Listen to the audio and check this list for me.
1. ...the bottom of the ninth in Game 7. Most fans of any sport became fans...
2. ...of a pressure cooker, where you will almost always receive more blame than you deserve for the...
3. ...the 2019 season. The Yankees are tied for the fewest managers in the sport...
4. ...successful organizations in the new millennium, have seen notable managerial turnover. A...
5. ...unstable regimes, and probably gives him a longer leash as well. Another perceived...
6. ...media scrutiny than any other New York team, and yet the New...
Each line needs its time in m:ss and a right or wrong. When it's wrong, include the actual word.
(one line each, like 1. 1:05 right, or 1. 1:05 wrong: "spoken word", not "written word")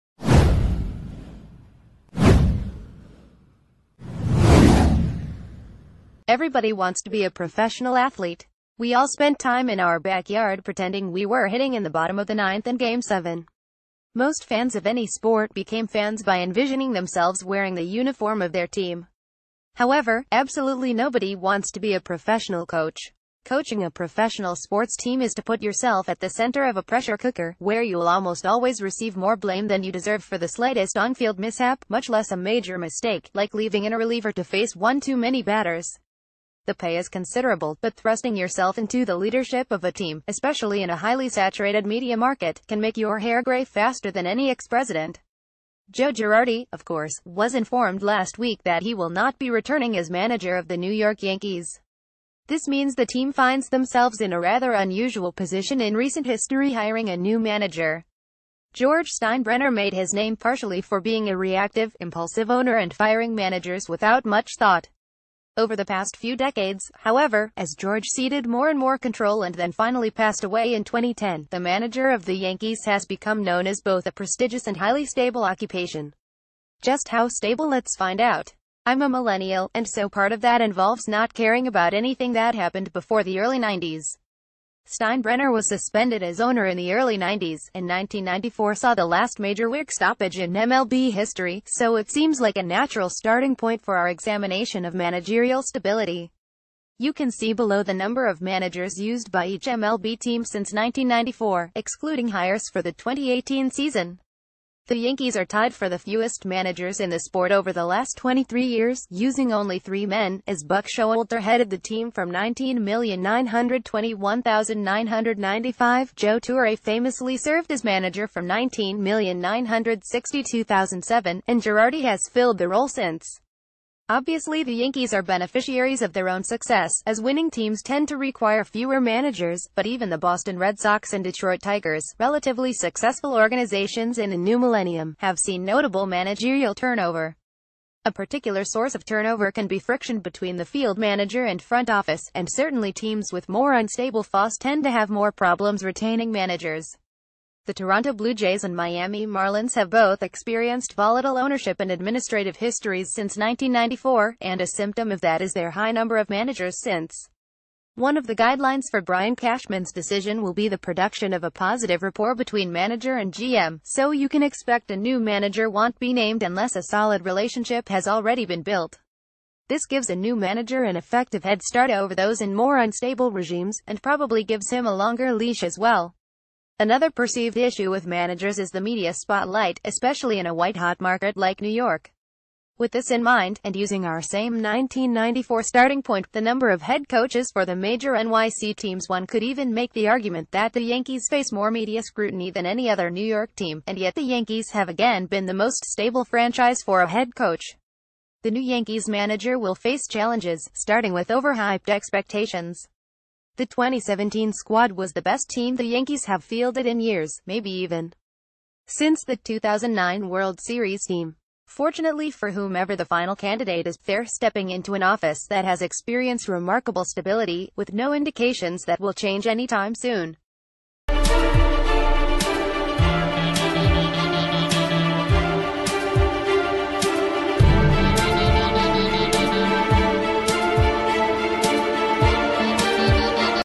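1. 0:11 right
2. 0:26 right
3. 1:42 wrong: "2018", not "2019"
4. 2:12 right
5. 2:52 right
6. 3:11 wrong: "Yankees", not "New".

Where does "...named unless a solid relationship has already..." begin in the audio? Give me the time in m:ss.
2:46.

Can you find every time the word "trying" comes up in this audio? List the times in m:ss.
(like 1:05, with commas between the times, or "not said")
not said.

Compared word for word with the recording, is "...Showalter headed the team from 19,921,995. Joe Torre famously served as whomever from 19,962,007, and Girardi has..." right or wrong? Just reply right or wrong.
wrong.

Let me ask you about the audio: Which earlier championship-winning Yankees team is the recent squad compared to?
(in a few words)
2009 World Series team.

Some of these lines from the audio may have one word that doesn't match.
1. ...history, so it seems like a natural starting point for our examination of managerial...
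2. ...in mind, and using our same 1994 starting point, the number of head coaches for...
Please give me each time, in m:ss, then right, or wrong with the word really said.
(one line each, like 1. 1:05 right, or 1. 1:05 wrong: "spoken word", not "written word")
1. 1:31 right
2. 3:03 right.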